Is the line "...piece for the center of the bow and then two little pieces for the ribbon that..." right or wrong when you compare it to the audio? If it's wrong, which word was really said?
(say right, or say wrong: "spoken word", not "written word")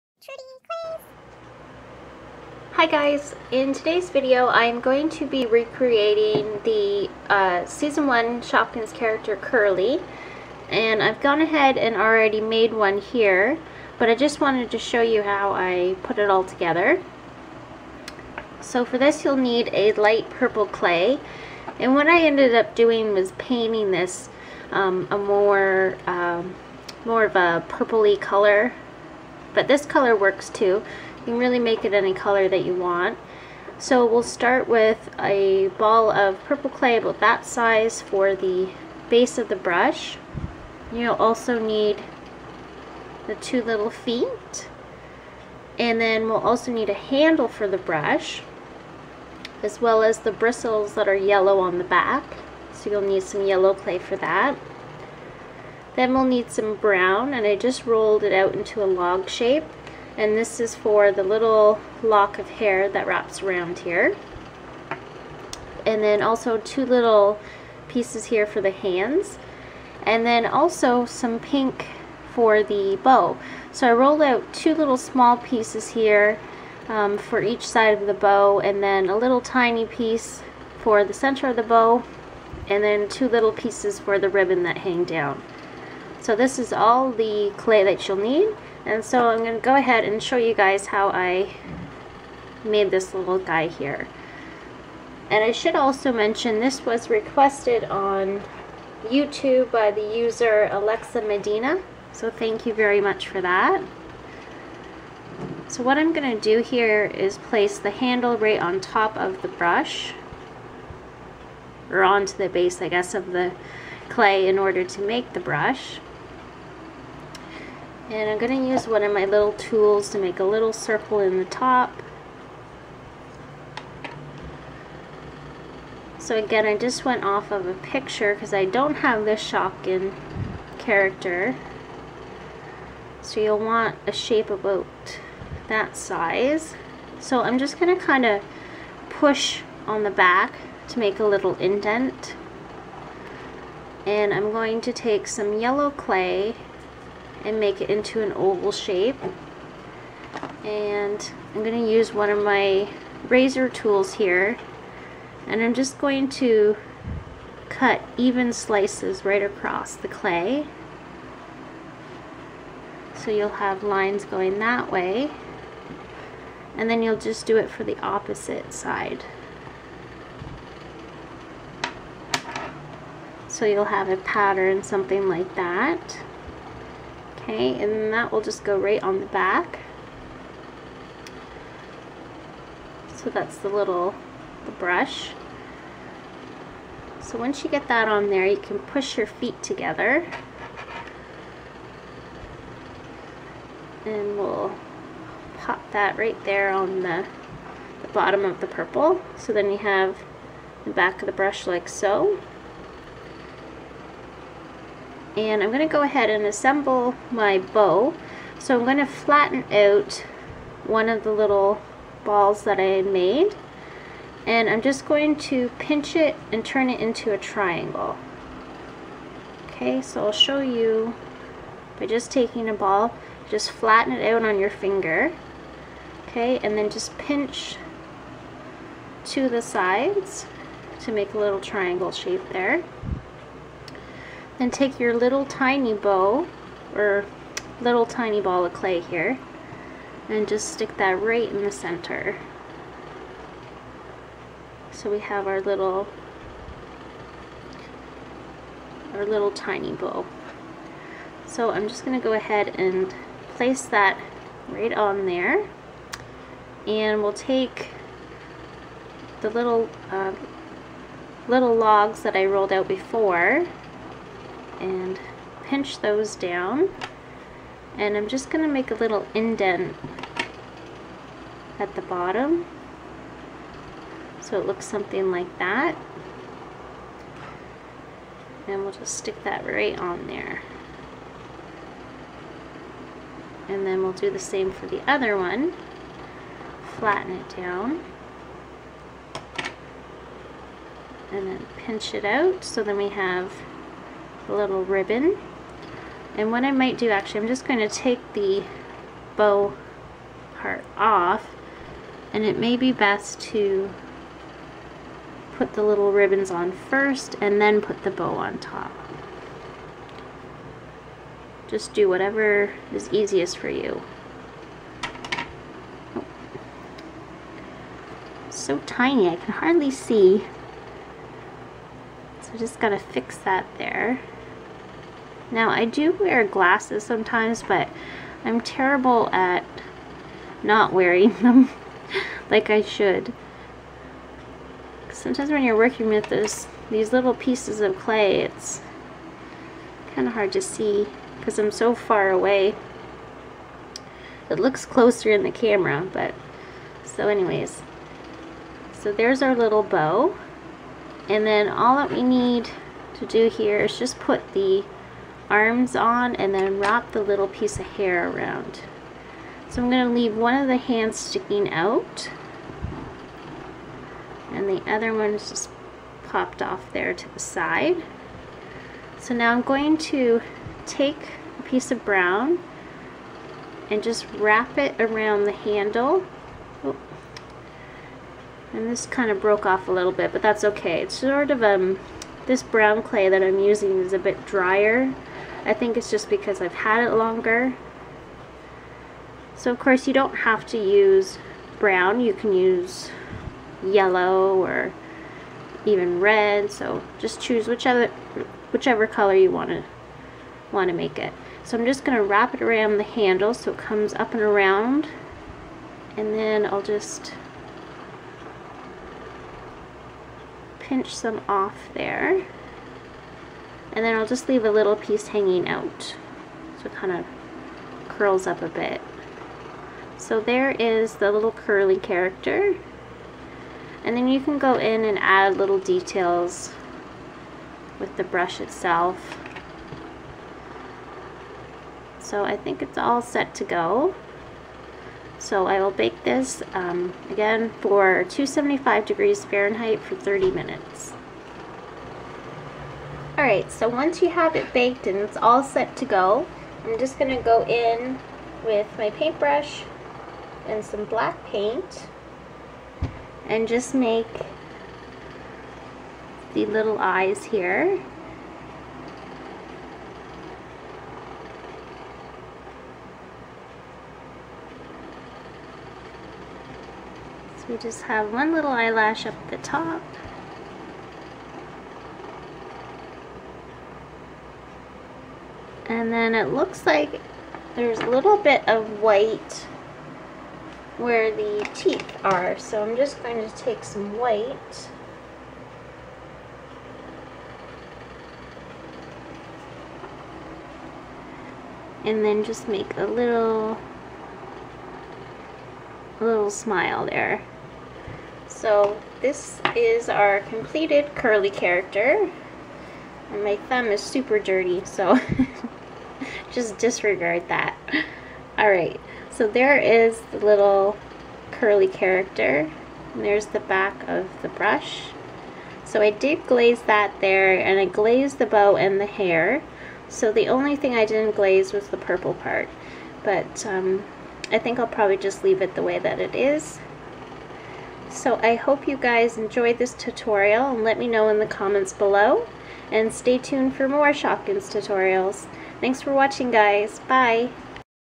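right.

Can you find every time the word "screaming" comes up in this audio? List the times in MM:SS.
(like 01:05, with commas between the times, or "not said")
not said.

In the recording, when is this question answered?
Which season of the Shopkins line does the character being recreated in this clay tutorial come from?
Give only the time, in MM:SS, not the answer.
00:07.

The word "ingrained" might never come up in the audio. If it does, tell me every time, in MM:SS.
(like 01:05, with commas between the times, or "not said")
not said.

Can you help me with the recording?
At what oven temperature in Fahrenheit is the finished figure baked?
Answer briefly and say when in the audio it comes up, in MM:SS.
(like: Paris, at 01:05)
275 degrees, at 07:18.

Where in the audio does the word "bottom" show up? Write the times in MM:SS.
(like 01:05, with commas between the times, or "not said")
03:18, 04:32.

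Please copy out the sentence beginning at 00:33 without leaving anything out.
So we'll start with a ball of purple clay about that size for the base of the brush.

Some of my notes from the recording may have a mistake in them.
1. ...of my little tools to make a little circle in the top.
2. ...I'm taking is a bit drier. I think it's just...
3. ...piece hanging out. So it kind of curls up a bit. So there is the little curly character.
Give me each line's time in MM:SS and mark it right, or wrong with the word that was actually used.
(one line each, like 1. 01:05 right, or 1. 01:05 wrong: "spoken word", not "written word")
1. 01:59 right
2. 06:23 wrong: "using", not "taking"
3. 06:54 right.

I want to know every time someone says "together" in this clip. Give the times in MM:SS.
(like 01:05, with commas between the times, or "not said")
00:16, 03:09.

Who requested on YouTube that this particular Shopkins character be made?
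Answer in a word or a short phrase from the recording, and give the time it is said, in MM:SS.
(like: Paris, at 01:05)
Alexa Medina, at 01:40.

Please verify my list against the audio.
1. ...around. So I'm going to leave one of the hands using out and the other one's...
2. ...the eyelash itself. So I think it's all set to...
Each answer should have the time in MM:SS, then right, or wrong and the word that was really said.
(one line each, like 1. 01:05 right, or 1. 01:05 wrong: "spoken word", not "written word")
1. 05:58 wrong: "sticking", not "using"
2. 07:08 wrong: "brush", not "eyelash".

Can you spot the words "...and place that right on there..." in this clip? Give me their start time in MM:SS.
04:12.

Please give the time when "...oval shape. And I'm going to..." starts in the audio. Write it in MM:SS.
02:28.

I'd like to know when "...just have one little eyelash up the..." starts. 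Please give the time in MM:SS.
07:47.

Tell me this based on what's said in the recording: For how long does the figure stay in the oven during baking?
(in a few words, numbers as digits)
30 minutes.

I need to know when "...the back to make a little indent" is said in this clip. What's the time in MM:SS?
02:20.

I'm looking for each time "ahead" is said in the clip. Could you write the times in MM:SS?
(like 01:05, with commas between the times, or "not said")
00:11, 01:29, 03:26, 04:12.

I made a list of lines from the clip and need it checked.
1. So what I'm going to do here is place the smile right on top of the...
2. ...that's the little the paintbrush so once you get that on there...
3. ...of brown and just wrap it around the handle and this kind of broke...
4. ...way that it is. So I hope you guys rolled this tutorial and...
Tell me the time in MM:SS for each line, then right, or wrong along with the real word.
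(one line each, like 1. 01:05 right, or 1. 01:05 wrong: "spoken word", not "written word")
1. 01:45 wrong: "handle", not "smile"
2. 03:03 wrong: "brush", not "paintbrush"
3. 06:11 right
4. 08:45 wrong: "enjoyed", not "rolled".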